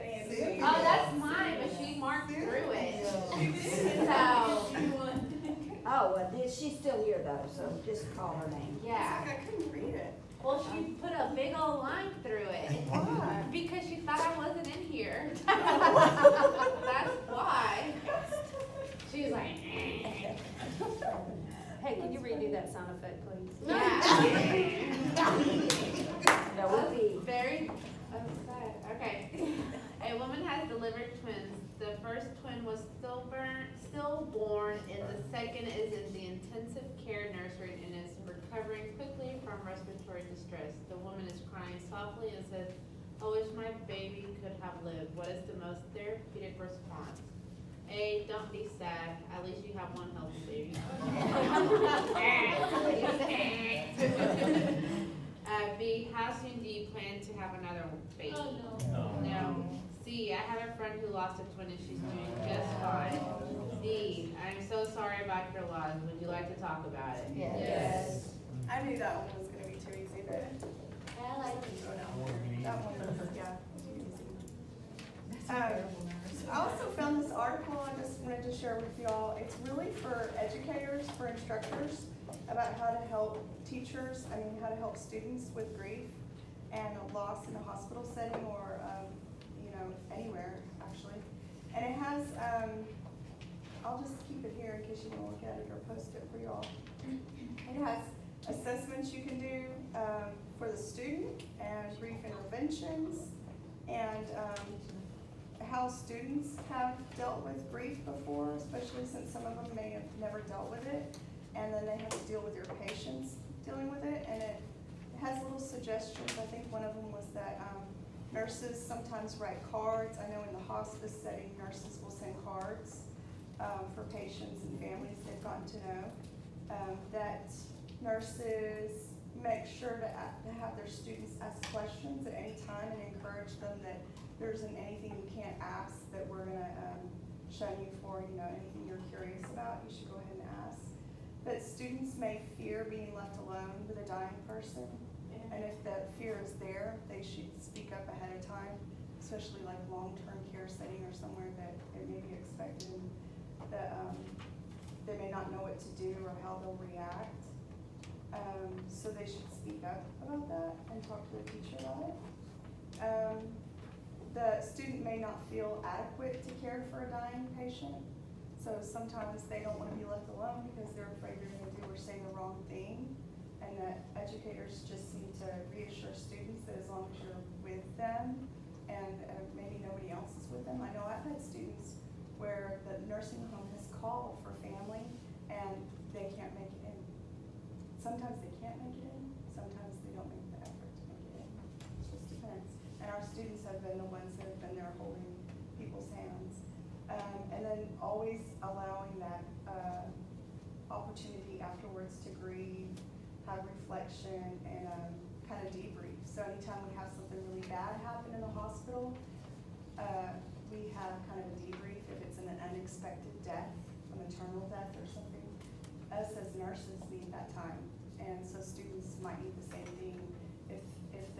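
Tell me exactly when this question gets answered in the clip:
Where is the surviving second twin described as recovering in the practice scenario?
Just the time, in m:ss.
0:36.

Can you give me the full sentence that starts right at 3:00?
I know I've had students where the nursing home has called for family and they can't make it in.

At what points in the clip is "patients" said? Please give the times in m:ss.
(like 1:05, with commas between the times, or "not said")
1:52, 2:04, 2:47.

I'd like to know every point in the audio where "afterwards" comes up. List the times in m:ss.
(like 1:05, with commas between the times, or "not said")
3:21.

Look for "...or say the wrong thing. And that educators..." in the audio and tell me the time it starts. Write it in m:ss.
2:51.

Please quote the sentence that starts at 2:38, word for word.
Um, so they should speak up about that and talk to the teacher about it.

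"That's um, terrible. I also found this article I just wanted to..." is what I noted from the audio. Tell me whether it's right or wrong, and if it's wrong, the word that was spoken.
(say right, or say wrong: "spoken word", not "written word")
right.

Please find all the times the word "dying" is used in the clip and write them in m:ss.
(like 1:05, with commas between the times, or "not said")
2:24, 2:47.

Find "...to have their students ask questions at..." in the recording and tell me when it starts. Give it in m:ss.
2:10.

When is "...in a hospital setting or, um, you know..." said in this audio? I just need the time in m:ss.
1:27.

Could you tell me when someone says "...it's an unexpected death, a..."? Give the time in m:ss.
3:32.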